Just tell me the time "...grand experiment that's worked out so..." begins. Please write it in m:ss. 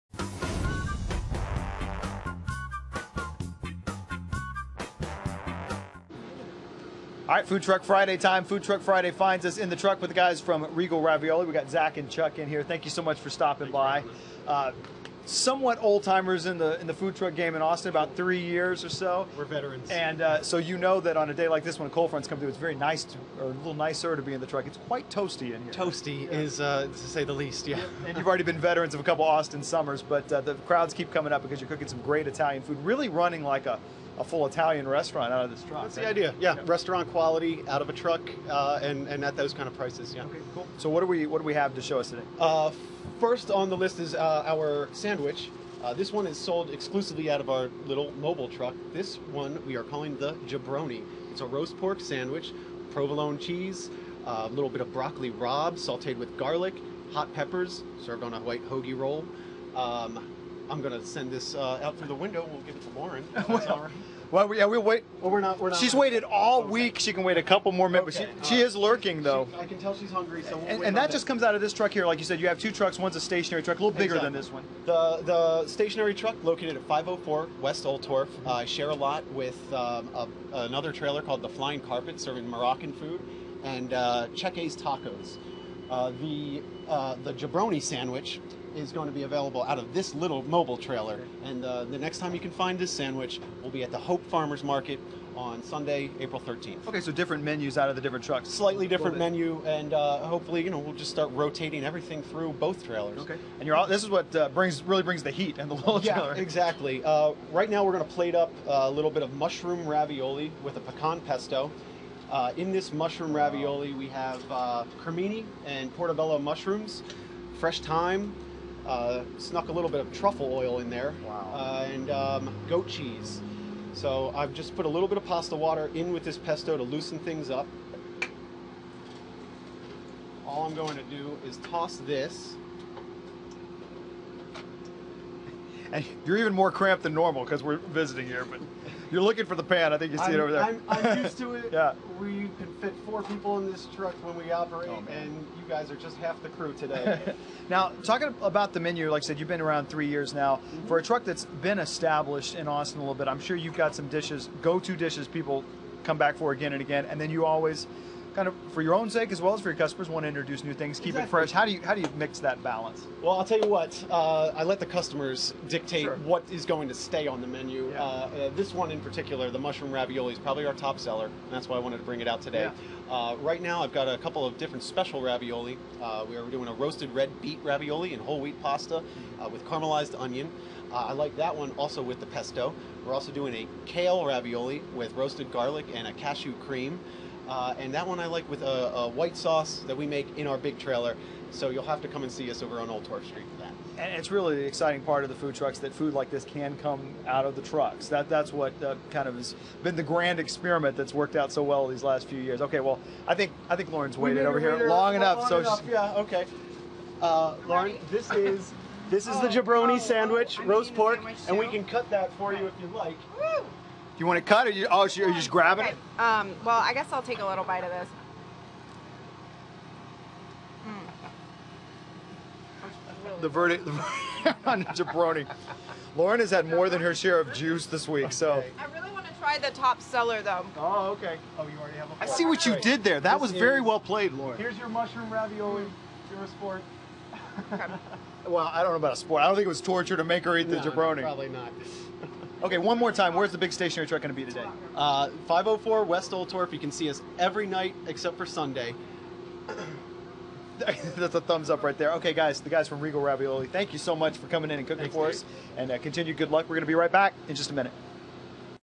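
3:20.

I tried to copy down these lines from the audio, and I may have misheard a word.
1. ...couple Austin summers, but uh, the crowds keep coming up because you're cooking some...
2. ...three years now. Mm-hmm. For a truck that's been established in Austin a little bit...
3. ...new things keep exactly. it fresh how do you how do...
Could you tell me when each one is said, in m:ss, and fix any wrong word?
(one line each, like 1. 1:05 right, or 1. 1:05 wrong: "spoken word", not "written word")
1. 0:29 right
2. 2:29 right
3. 2:40 right.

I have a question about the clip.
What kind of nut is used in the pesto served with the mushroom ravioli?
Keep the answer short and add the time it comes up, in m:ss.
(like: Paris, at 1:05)
Pecan, at 1:50.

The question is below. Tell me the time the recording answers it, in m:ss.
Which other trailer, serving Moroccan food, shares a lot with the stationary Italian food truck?
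1:21.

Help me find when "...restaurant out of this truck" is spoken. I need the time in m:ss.
0:34.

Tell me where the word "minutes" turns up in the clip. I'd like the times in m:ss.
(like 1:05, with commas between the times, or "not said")
1:07, 4:17.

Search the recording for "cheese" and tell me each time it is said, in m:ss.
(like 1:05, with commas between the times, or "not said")
0:53, 2:02.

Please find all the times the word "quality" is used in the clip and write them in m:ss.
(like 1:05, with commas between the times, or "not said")
0:37.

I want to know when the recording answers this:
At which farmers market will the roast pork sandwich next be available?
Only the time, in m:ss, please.
1:33.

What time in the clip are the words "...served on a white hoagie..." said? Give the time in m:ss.
0:58.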